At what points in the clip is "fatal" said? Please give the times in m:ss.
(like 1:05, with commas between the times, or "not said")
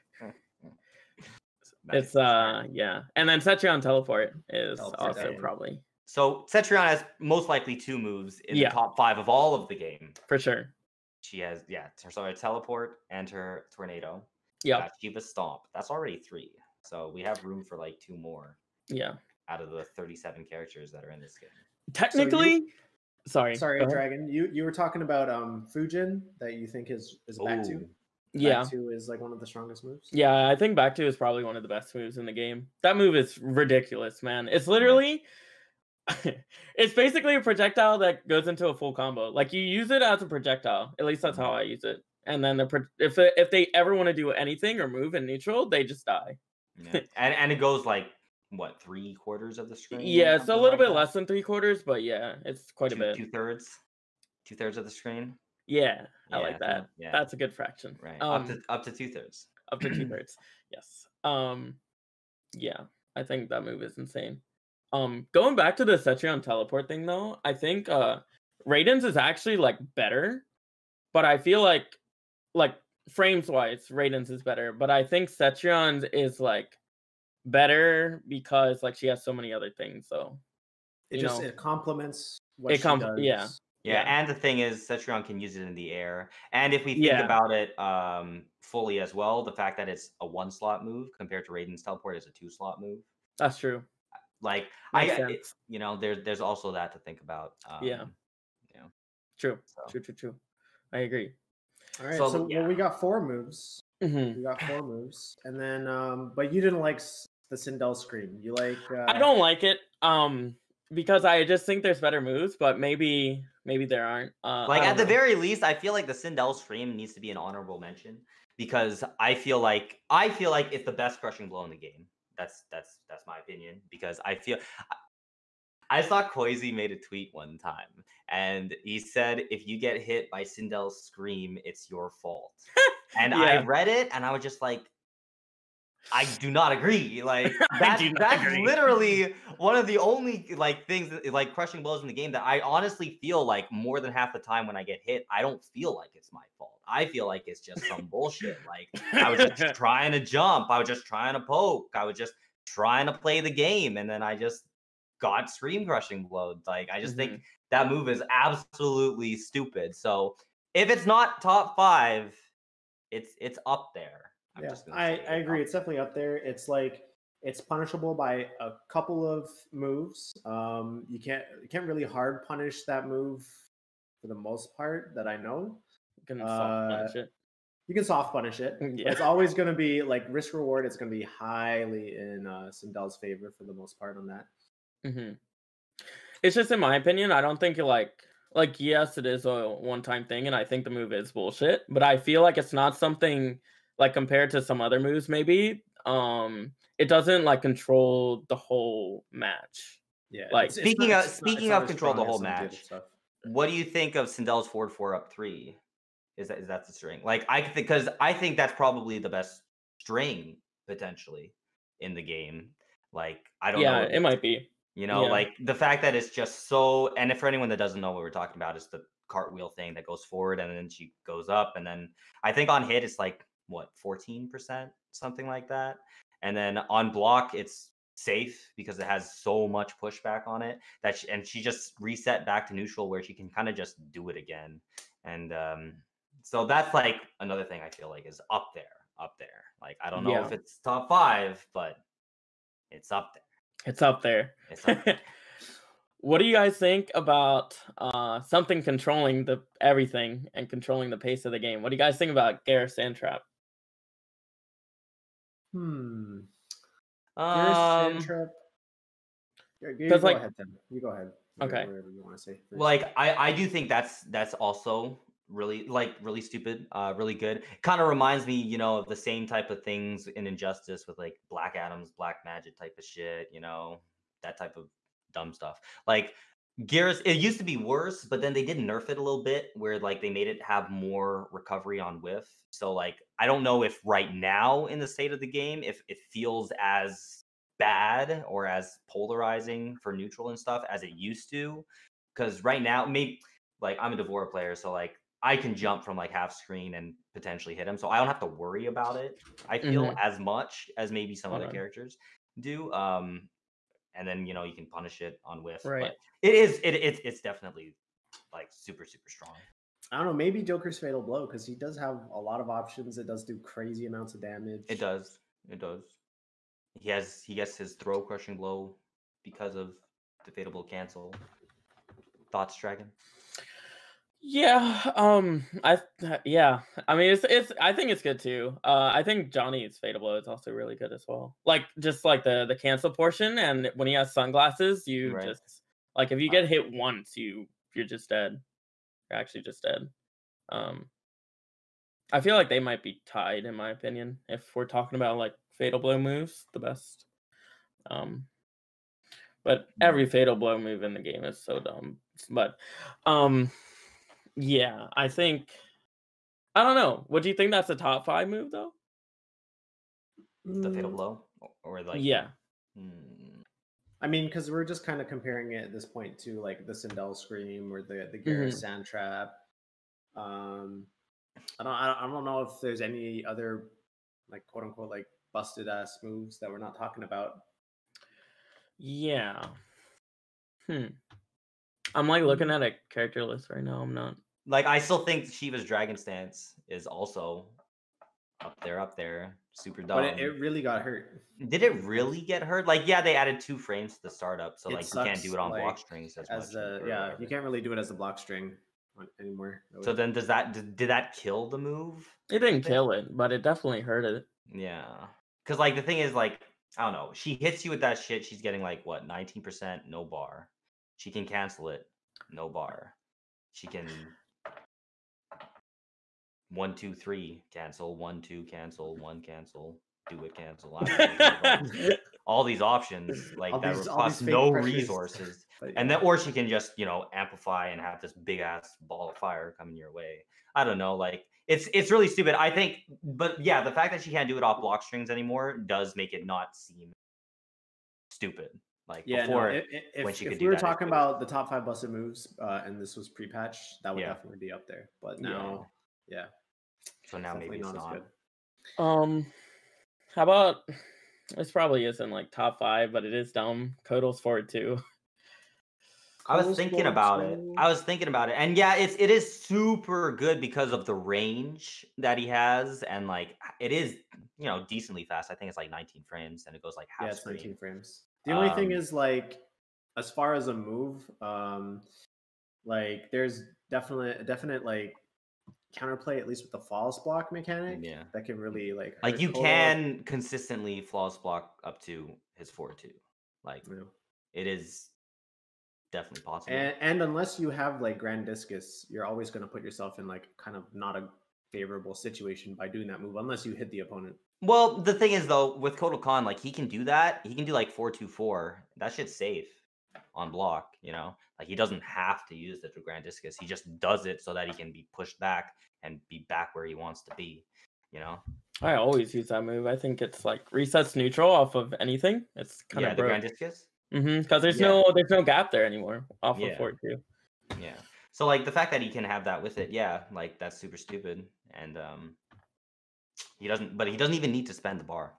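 5:10, 5:20, 5:29, 5:45, 5:50, 6:00.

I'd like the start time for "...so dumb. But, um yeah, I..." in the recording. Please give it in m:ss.
5:51.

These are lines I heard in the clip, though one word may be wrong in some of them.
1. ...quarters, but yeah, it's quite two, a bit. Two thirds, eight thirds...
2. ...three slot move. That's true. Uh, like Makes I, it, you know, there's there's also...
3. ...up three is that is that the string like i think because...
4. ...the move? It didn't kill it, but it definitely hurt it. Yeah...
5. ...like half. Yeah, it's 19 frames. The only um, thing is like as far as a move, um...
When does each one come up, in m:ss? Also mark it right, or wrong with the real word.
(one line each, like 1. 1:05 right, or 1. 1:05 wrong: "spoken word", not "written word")
1. 0:51 wrong: "two", not "eight"
2. 1:32 wrong: "two", not "three"
3. 3:25 right
4. 6:41 right
5. 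7:46 right.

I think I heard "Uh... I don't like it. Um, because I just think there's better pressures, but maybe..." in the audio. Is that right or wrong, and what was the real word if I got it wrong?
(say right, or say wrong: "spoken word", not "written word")
wrong: "moves", not "pressures".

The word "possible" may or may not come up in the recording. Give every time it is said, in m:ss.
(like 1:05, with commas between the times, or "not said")
8:06.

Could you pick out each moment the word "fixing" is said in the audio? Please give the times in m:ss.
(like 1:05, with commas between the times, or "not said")
not said.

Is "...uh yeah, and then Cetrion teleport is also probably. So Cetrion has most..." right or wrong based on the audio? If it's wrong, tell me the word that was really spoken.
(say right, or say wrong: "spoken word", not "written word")
right.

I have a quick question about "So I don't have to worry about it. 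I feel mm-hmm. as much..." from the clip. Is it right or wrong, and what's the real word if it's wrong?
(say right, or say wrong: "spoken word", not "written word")
right.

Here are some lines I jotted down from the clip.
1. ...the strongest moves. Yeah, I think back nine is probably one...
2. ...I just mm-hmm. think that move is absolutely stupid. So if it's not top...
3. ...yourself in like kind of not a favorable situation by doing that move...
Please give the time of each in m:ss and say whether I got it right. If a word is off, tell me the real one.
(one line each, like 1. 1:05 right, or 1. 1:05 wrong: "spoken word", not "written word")
1. 0:29 wrong: "two", not "nine"
2. 2:36 right
3. 8:09 right.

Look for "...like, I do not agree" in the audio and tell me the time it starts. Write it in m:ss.
2:14.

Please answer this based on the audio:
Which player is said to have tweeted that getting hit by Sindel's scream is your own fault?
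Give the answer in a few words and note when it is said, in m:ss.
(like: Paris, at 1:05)
Koizy, at 2:06.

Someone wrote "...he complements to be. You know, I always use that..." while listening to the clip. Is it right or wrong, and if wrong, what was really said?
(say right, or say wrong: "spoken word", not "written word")
wrong: "wants", not "complements".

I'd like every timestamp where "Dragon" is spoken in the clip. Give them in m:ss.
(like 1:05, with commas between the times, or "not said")
0:23, 5:22, 6:25.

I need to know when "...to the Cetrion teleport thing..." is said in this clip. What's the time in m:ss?
1:05.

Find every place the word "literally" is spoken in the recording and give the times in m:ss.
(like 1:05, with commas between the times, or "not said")
0:34, 2:18.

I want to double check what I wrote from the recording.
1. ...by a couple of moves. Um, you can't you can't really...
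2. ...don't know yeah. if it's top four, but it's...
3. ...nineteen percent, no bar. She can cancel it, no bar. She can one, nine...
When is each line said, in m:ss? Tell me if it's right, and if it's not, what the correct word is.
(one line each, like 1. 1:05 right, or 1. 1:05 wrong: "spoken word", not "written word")
1. 2:48 right
2. 4:00 wrong: "five", not "four"
3. 6:49 wrong: "two", not "nine".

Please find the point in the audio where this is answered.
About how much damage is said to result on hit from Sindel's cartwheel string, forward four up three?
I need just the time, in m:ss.
3:44.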